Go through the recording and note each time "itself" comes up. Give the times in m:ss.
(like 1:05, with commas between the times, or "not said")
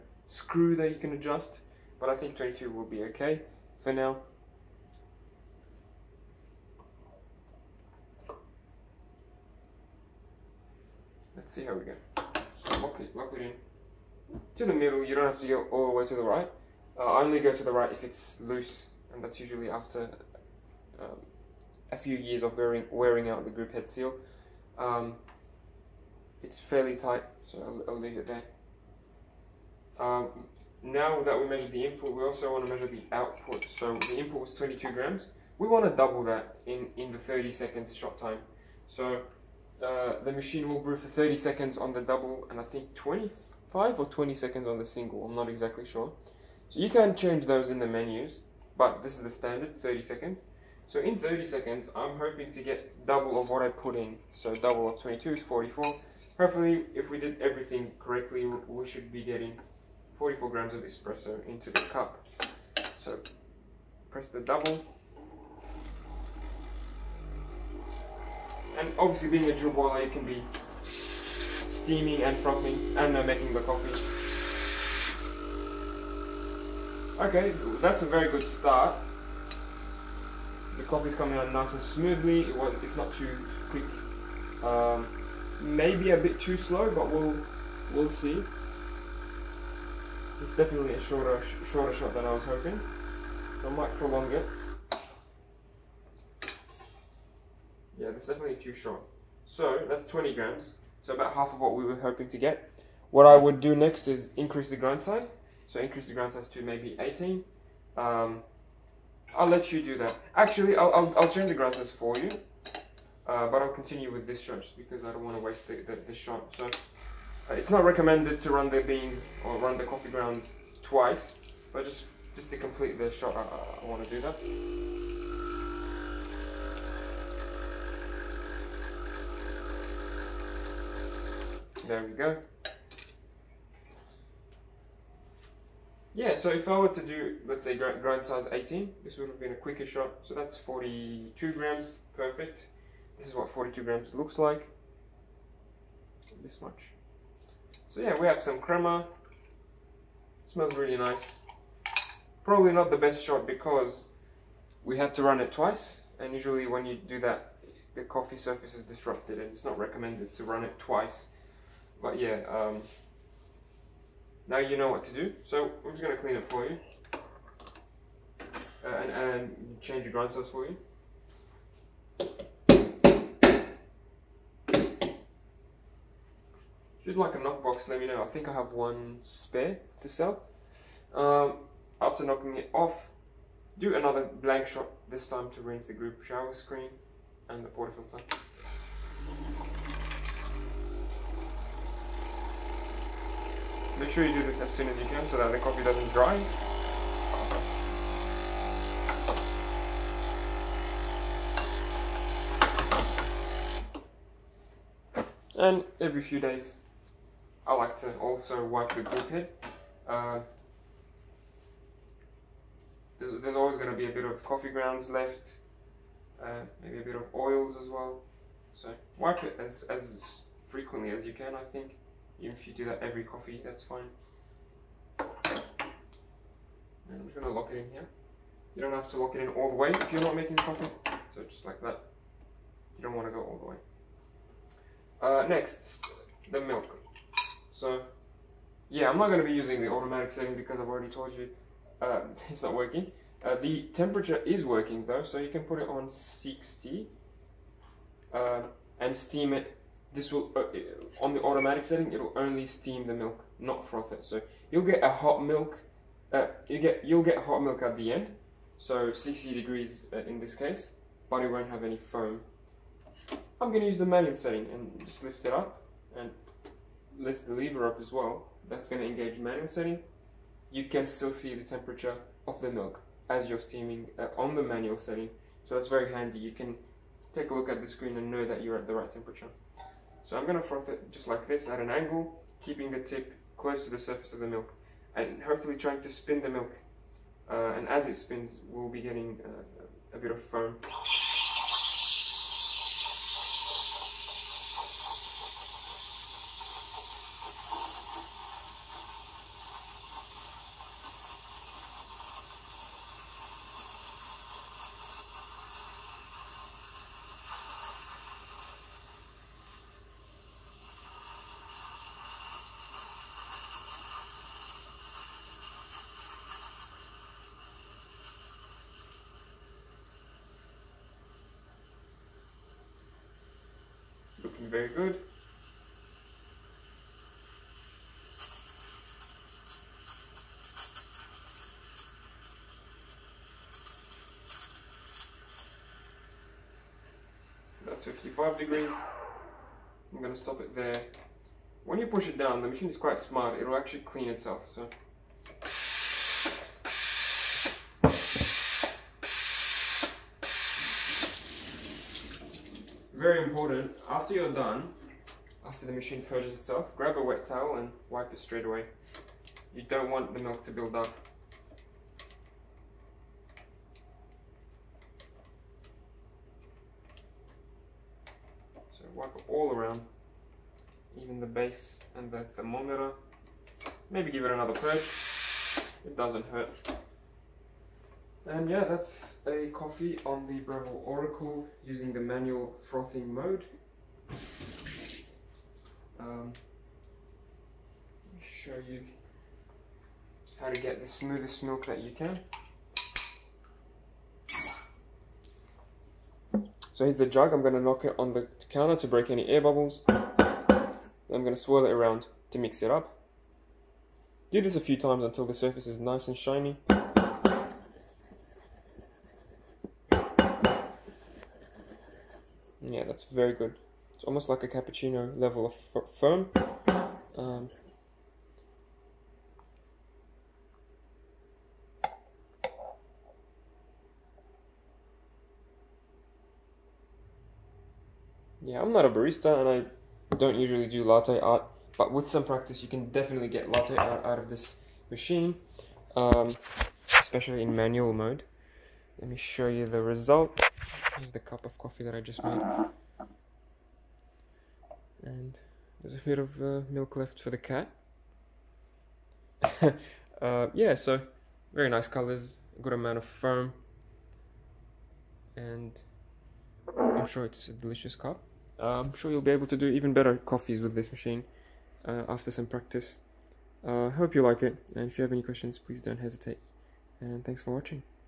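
5:44, 5:56.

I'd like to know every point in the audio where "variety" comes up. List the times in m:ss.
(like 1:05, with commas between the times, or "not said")
not said.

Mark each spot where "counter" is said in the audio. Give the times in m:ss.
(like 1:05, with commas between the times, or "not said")
6:38.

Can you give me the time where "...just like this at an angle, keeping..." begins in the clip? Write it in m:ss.
4:41.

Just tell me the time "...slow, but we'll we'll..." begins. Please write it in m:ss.
1:26.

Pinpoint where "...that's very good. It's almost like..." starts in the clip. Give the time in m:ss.
6:53.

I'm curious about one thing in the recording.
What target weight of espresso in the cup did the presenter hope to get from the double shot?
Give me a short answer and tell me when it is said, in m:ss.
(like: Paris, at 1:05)
44 grams, at 1:00.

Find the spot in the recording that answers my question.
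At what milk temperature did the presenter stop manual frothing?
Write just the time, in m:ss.
5:38.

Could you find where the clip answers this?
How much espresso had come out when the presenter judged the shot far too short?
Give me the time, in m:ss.
1:39.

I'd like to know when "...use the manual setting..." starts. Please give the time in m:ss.
4:23.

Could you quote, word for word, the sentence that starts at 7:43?
I uh, hope you like it, and if you have any questions, please don't hesitate.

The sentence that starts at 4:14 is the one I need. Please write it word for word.
So you'll get a hot milk, uh, you get, you'll get hot milk at the end.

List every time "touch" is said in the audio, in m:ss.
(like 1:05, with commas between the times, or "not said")
not said.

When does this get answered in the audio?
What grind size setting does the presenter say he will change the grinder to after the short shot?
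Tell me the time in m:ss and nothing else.
1:46.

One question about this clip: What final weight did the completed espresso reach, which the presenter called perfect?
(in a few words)
42 grams.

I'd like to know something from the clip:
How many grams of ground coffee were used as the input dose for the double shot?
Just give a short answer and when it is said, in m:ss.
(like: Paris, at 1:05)
22 grams, at 0:33.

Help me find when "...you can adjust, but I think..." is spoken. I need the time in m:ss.
0:00.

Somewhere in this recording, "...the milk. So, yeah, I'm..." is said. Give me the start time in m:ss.
3:56.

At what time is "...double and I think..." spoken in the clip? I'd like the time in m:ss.
0:42.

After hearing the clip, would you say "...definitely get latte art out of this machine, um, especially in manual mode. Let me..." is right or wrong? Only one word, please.
right.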